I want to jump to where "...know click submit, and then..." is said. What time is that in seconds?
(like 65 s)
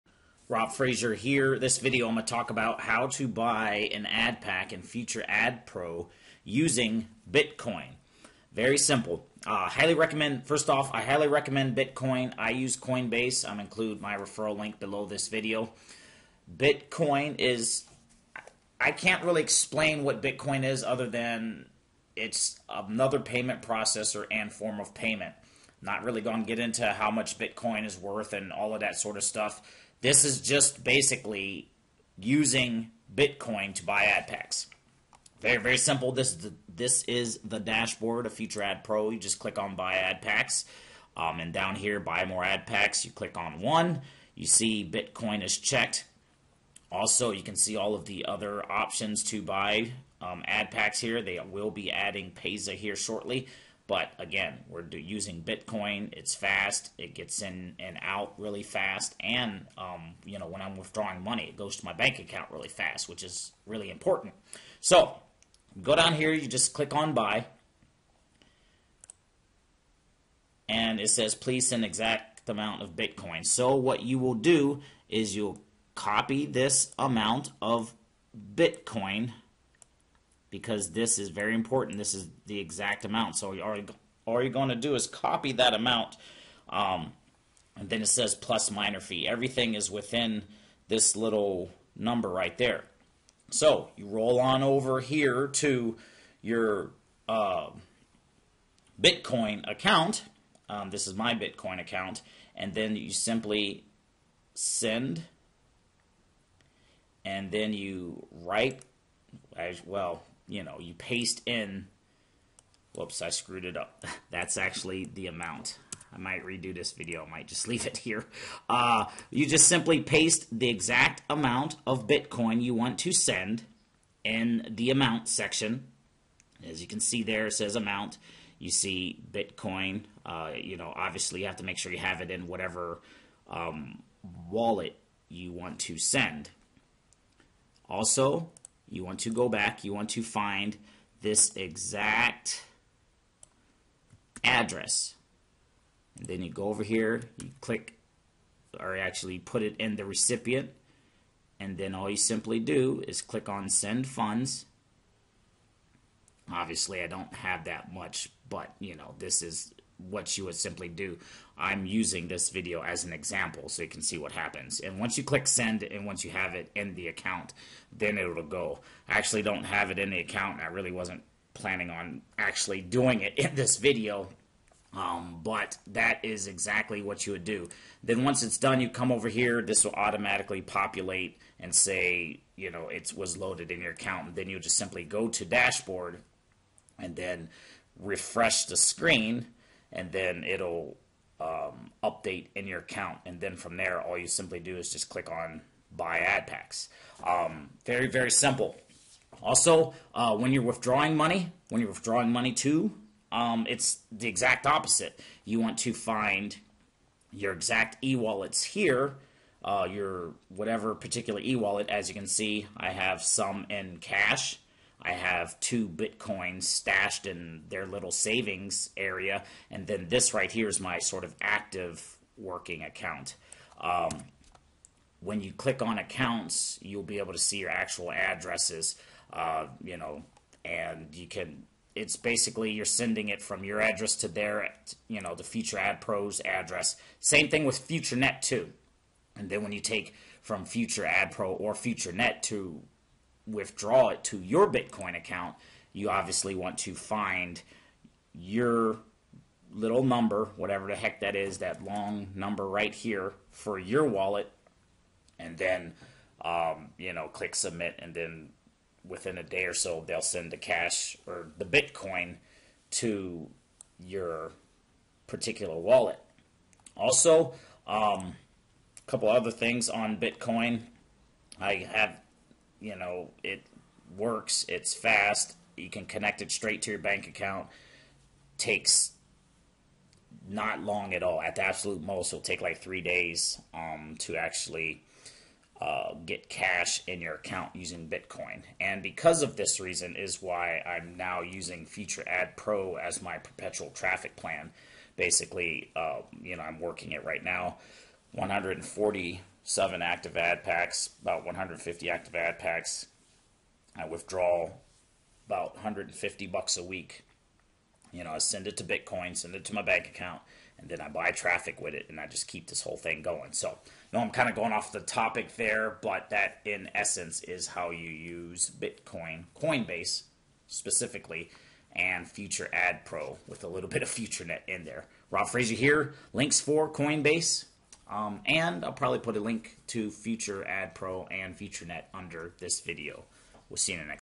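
257 s.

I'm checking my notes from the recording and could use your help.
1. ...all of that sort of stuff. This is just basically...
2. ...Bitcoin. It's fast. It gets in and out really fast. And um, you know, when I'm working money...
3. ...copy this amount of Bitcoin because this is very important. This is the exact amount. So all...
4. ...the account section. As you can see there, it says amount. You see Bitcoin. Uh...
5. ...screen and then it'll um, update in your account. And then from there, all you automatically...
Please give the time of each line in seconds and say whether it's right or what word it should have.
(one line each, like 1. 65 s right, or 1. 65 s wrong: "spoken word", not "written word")
1. 28 s right
2. 55 s wrong: "withdrawing", not "working"
3. 75 s right
4. 124 s wrong: "amount", not "account"
5. 188 s wrong: "simply", not "automatically".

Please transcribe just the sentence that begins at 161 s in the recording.
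I'm using this video as an example so you can see what happens.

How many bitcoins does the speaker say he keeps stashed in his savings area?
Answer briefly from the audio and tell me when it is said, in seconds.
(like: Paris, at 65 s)
2, at 215 s.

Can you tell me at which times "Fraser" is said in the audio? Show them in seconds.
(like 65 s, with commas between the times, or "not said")
0 s, 325 s.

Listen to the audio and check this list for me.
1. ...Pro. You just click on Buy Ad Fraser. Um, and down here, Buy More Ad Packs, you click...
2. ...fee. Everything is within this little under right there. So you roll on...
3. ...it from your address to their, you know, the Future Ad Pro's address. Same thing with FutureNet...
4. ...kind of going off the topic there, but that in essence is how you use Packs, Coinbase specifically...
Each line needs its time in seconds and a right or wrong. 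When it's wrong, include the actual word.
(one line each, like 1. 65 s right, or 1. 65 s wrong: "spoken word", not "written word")
1. 38 s wrong: "Packs", not "Fraser"
2. 88 s wrong: "number", not "under"
3. 233 s right
4. 314 s wrong: "Bitcoin", not "Packs".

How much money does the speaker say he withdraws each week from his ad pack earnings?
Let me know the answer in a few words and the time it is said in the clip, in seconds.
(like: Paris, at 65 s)
$150, at 305 s.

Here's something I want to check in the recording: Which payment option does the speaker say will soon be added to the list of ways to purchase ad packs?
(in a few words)
Payza.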